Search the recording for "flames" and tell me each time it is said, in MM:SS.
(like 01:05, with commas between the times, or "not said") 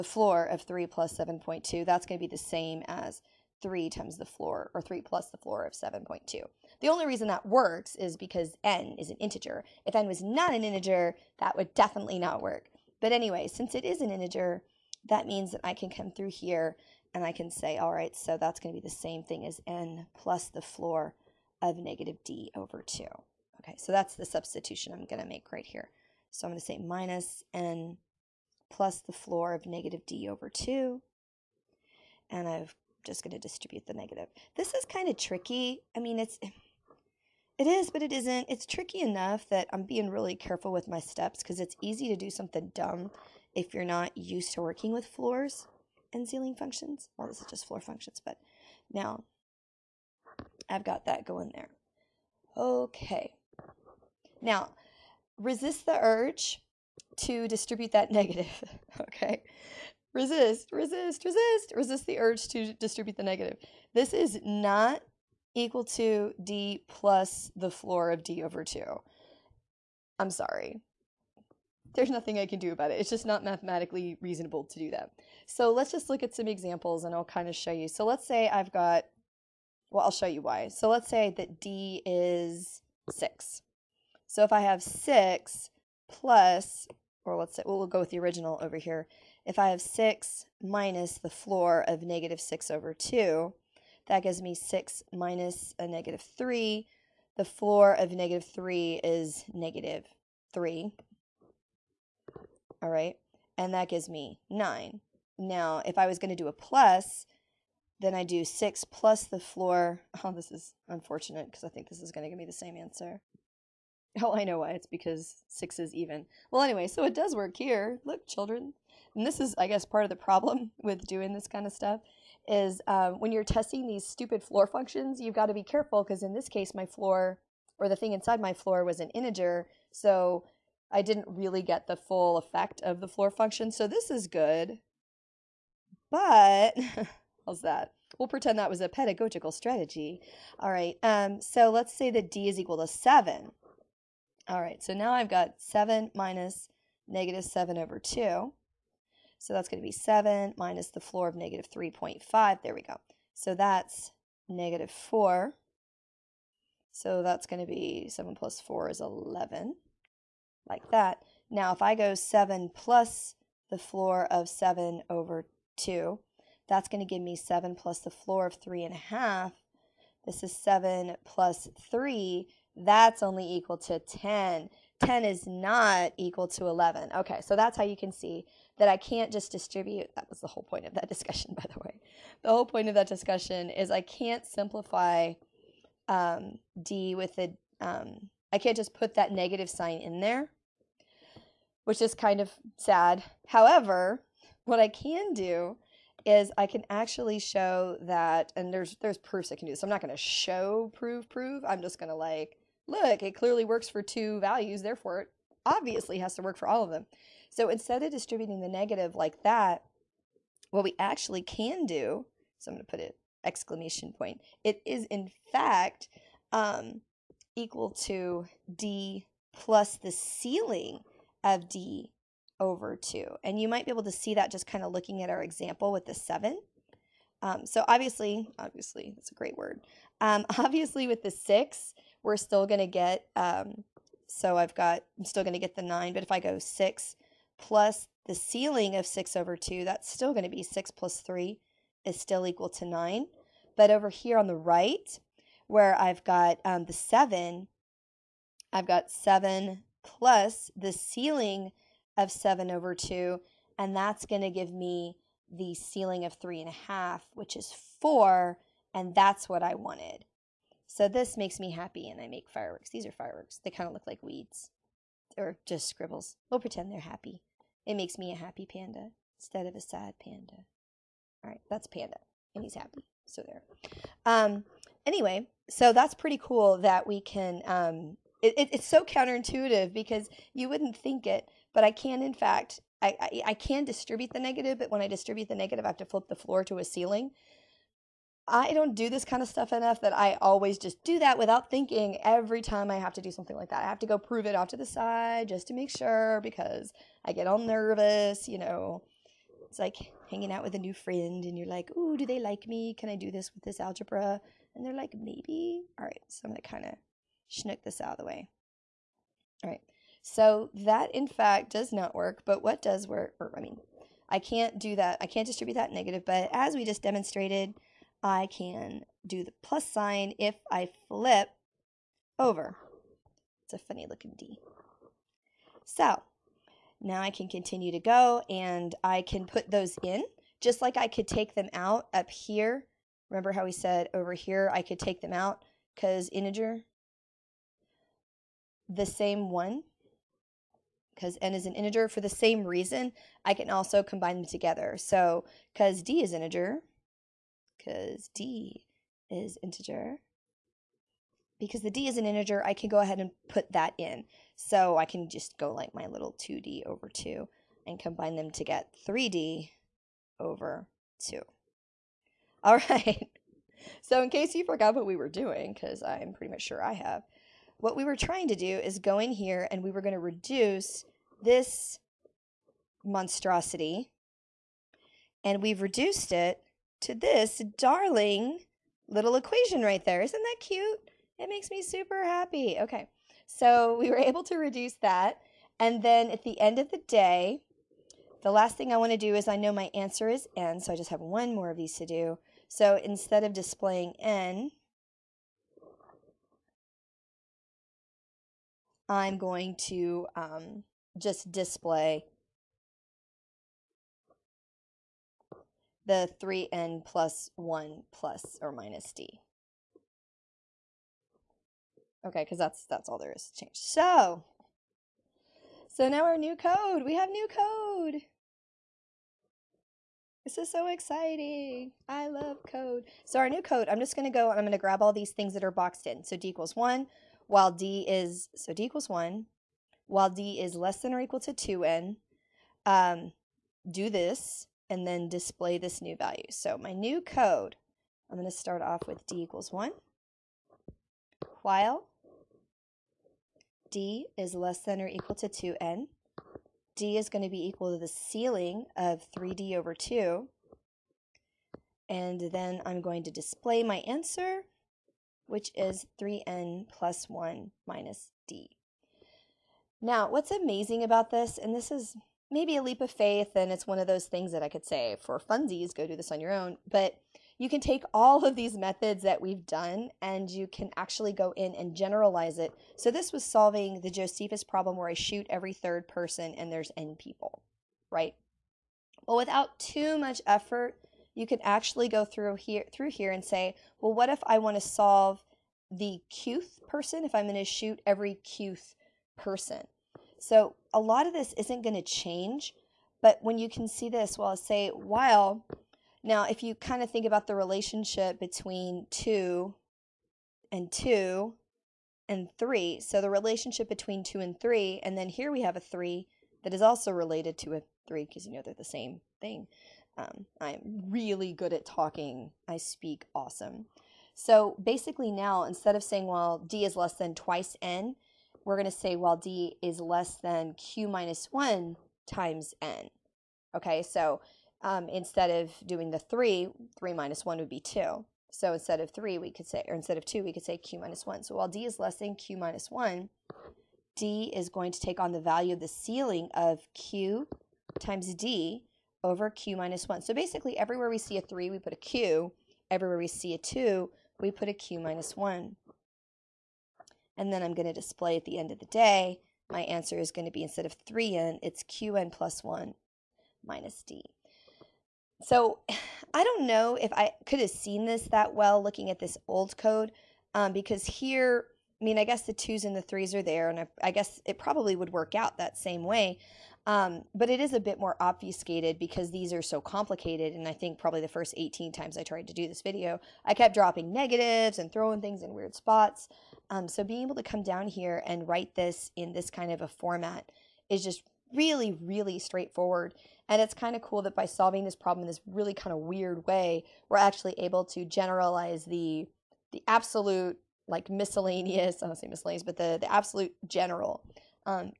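not said.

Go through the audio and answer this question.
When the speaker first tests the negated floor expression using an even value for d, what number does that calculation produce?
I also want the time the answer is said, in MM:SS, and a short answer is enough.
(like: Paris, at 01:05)
9, at 01:43.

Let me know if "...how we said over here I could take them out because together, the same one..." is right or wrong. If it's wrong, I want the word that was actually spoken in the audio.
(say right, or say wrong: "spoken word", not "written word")
wrong: "integer", not "together".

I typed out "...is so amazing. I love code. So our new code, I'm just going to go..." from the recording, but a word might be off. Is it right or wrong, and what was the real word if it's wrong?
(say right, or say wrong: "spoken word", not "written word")
wrong: "exciting", not "amazing".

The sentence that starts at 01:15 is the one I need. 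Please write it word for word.
So let's just look at some examples and I'll kind of show you.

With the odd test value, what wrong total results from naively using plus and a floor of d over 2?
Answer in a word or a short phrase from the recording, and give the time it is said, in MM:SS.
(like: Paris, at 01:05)
10, at 02:52.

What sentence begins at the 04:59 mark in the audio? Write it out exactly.
It's like hanging out with a new friend and you're like, "Ooh, do they like me?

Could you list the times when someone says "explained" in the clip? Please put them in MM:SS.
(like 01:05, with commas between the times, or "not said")
not said.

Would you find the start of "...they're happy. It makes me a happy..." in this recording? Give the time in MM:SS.
04:26.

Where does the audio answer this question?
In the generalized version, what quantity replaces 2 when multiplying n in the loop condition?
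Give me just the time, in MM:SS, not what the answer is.
08:40.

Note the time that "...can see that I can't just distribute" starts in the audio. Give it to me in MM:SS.
02:57.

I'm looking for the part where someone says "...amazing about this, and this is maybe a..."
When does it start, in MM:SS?
07:40.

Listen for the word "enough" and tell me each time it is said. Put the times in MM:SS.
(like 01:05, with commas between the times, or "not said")
00:39, 04:49.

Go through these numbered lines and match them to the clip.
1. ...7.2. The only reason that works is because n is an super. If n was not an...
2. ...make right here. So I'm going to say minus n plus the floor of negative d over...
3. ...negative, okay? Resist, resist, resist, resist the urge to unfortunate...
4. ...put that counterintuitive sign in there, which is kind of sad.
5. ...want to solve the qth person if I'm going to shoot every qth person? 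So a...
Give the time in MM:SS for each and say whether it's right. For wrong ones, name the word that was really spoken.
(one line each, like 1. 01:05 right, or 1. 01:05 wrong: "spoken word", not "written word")
1. 00:05 wrong: "integer", not "super"
2. 00:25 right
3. 00:58 wrong: "distribute", not "unfortunate"
4. 03:08 wrong: "negative", not "counterintuitive"
5. 08:04 right.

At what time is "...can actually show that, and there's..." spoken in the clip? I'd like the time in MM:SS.
03:16.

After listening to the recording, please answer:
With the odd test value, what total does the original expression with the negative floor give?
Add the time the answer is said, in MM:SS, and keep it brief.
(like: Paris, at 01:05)
11, at 02:38.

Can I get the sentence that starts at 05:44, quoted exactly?
So because d is integer, because D is integer.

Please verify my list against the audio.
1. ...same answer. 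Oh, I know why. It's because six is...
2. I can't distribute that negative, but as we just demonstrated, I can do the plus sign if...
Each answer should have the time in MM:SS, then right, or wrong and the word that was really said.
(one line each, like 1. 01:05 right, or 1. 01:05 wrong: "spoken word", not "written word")
1. 01:52 right
2. 05:15 right.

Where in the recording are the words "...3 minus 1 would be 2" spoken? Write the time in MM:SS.
08:46.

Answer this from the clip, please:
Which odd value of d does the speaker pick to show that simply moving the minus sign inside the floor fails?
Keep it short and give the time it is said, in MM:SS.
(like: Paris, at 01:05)
7, at 02:22.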